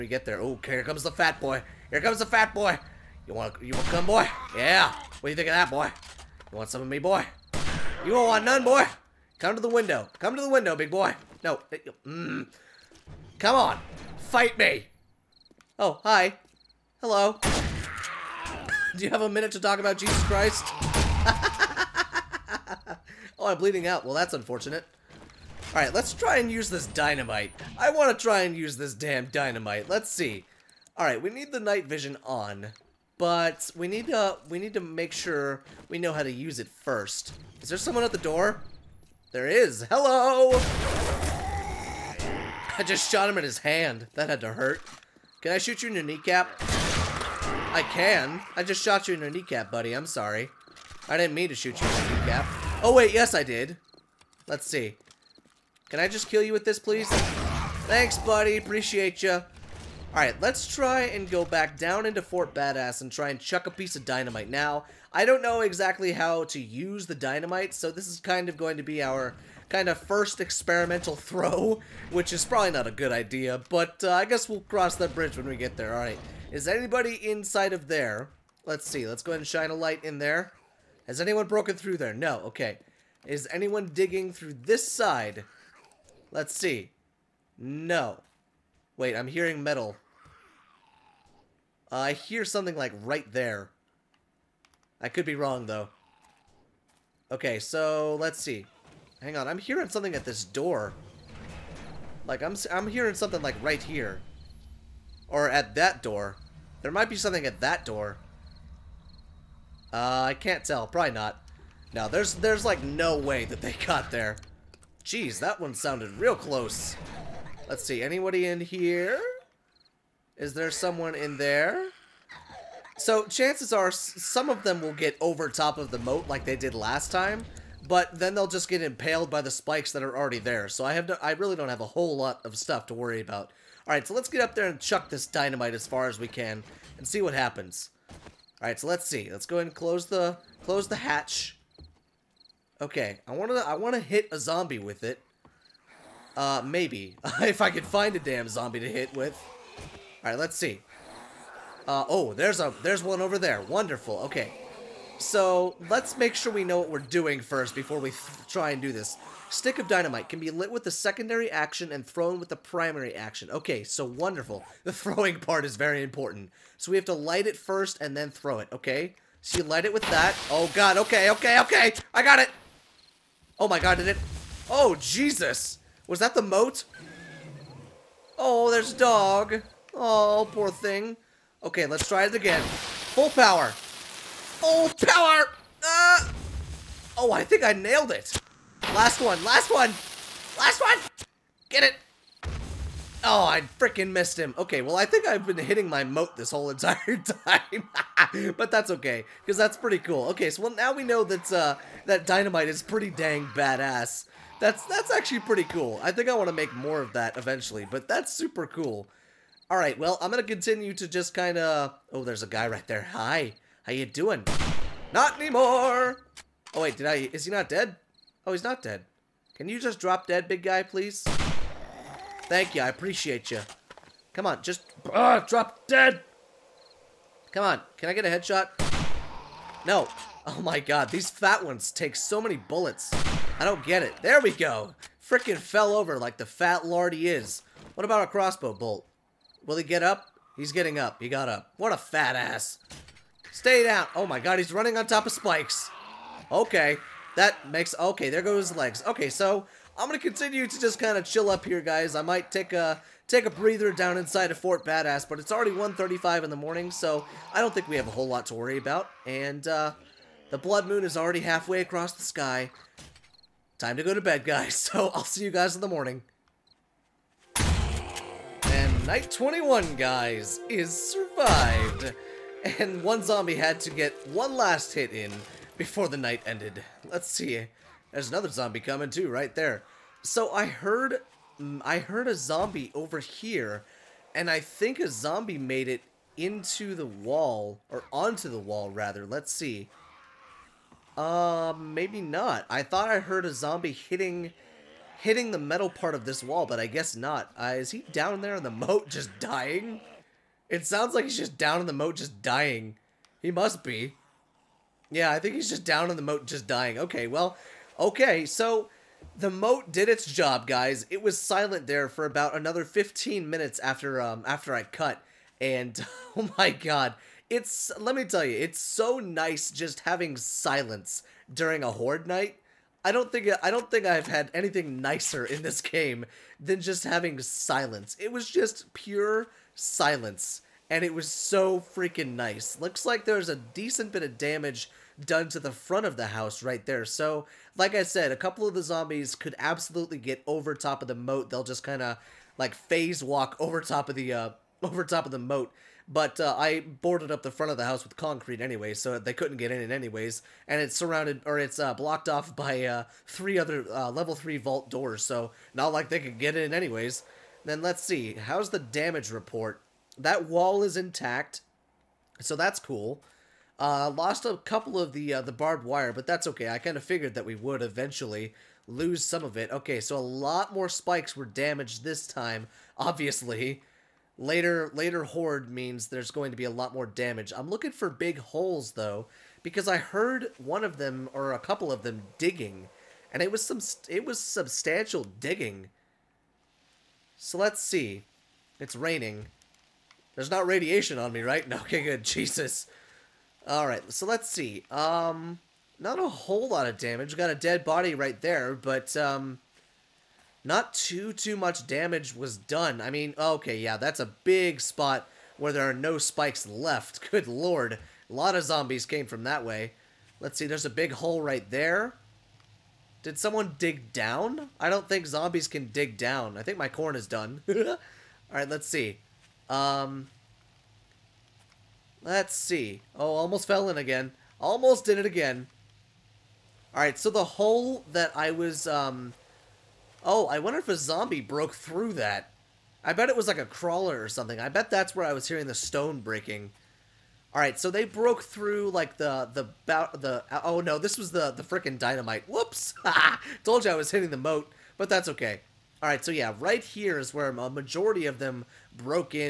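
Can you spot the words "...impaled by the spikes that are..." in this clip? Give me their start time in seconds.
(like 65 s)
128 s.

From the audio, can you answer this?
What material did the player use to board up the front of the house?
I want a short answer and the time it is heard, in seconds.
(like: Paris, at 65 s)
concrete, at 348 s.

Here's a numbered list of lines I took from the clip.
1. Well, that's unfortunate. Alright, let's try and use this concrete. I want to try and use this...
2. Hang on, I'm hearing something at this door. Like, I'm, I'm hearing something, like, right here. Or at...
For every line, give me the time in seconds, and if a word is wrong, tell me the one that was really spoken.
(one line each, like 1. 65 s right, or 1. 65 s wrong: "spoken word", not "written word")
1. 24 s wrong: "dynamite", not "concrete"
2. 99 s right.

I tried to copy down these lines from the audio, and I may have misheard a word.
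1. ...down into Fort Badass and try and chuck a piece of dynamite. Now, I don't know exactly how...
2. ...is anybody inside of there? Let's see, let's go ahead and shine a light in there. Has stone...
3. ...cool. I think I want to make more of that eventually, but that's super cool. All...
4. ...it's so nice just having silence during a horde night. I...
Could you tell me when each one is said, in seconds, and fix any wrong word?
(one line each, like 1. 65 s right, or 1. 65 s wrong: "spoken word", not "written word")
1. 61 s right
2. 76 s wrong: "anyone", not "stone"
3. 205 s right
4. 318 s right.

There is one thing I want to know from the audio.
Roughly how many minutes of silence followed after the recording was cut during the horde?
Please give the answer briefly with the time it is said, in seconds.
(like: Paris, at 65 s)
15, at 312 s.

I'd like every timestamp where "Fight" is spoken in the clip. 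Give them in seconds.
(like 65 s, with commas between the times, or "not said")
14 s.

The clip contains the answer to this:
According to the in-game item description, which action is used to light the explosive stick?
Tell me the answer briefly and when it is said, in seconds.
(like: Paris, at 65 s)
secondary action, at 160 s.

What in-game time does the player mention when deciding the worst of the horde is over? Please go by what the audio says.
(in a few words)
1:35 in the morning.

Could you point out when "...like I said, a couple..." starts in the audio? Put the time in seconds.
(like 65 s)
337 s.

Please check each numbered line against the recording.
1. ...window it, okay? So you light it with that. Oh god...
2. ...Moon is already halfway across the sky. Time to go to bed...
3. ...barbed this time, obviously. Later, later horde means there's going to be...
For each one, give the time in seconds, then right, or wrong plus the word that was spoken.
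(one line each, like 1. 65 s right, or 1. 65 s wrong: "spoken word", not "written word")
1. 168 s wrong: "throw", not "window"
2. 260 s right
3. 371 s wrong: "damaged", not "barbed".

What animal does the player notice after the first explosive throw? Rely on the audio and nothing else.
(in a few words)
a dog.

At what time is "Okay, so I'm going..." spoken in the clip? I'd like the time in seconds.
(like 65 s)
249 s.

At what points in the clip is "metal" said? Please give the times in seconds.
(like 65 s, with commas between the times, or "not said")
89 s, 295 s.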